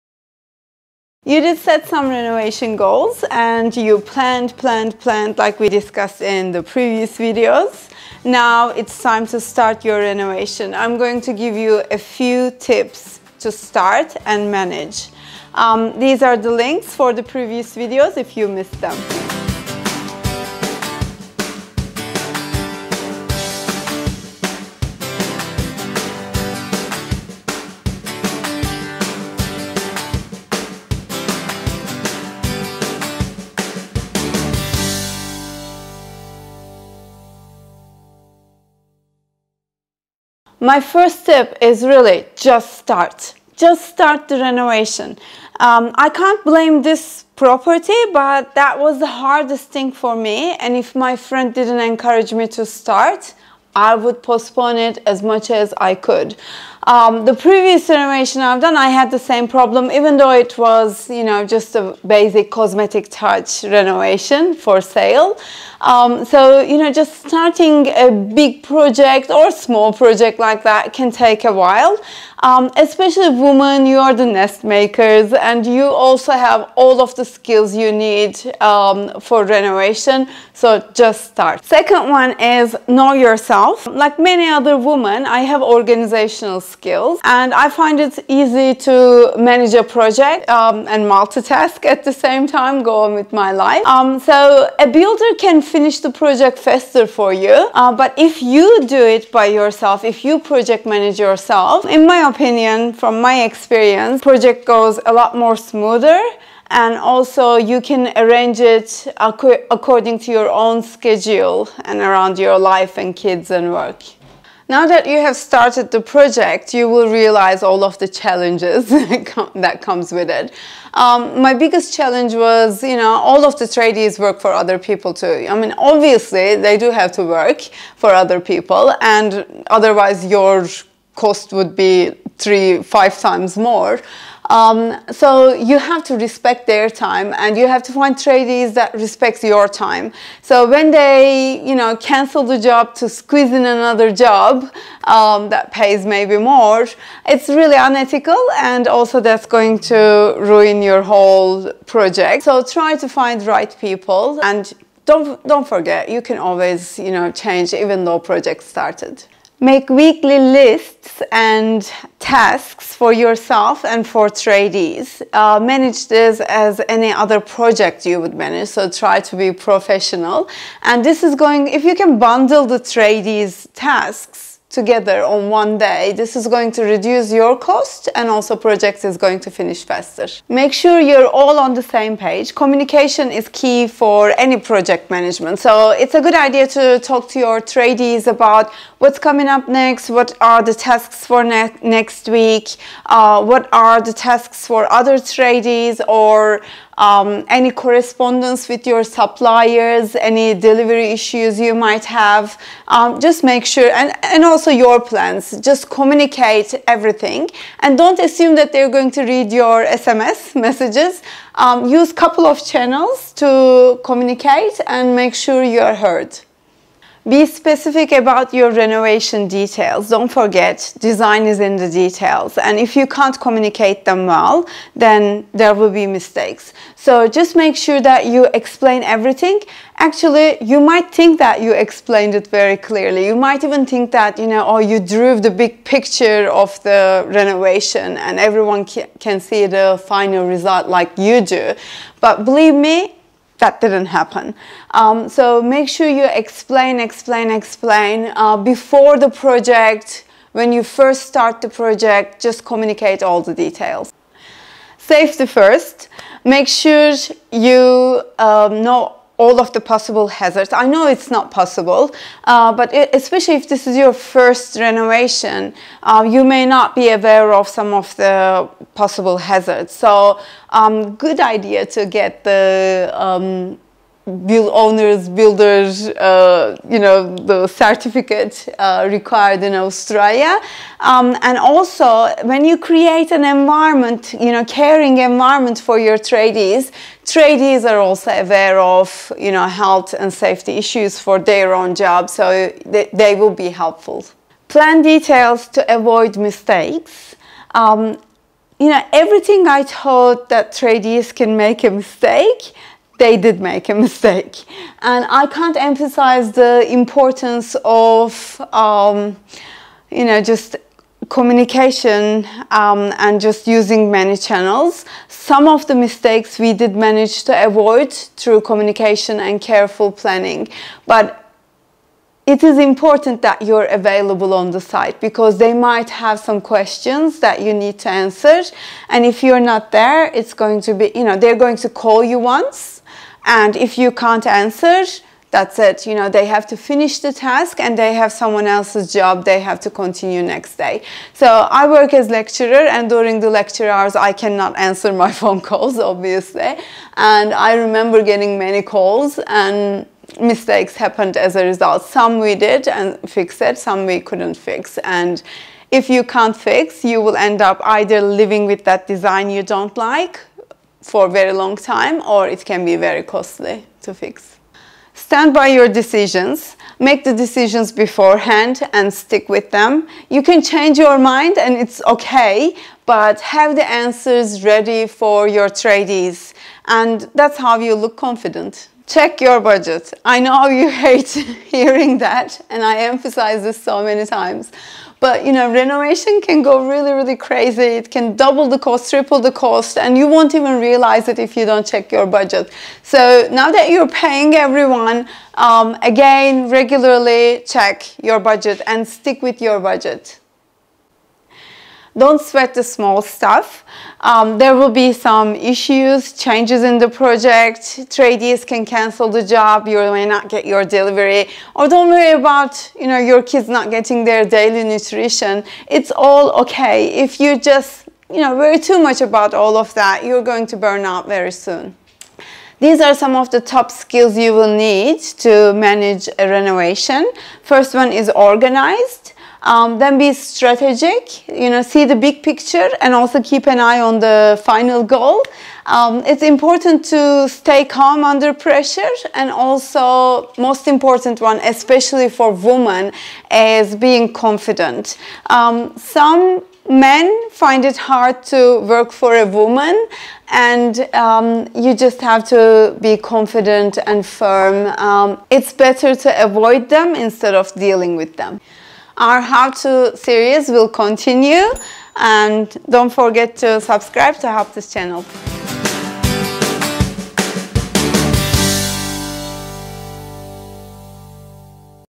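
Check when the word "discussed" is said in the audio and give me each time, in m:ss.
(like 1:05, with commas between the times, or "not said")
0:05.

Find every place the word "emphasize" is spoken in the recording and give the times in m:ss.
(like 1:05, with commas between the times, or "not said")
5:05, 6:22.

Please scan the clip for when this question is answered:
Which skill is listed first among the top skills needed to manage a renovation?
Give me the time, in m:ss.
7:08.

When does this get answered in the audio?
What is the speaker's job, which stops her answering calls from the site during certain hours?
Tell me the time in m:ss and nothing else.
5:42.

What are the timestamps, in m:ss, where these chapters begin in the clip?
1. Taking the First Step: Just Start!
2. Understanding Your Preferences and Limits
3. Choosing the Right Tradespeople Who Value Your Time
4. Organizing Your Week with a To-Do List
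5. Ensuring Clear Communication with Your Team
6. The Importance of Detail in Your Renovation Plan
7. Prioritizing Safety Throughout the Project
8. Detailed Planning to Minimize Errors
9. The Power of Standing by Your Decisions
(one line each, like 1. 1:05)
1. 0:43
2. 1:22
3. 1:56
4. 2:41
5. 3:02
6. 3:39
7. 4:16
8. 4:55
9. 6:07.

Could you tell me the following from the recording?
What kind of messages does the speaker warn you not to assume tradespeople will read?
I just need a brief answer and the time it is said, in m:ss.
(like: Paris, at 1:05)
SMS messages, at 3:29.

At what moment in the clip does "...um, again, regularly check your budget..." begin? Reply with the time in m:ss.
6:35.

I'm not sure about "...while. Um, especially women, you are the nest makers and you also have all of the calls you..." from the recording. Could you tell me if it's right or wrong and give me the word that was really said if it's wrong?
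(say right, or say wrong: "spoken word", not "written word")
wrong: "skills", not "calls".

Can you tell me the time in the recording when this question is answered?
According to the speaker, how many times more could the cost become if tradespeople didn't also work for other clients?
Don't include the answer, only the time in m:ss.
2:12.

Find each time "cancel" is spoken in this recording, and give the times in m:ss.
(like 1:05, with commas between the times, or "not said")
2:21, 6:48.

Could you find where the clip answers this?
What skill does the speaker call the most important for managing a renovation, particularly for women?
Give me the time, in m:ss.
7:23.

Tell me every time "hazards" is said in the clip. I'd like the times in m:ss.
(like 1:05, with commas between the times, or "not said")
4:20, 4:29.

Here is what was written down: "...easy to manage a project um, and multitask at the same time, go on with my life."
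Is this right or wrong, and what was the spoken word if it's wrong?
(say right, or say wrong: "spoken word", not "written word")
right.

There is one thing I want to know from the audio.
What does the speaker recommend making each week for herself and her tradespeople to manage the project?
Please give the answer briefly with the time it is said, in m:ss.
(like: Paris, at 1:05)
Lists and tasks, at 2:39.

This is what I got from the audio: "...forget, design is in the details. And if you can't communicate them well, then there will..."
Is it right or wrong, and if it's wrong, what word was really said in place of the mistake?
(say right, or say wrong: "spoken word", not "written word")
right.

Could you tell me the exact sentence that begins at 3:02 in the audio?
Communication is key for any project management.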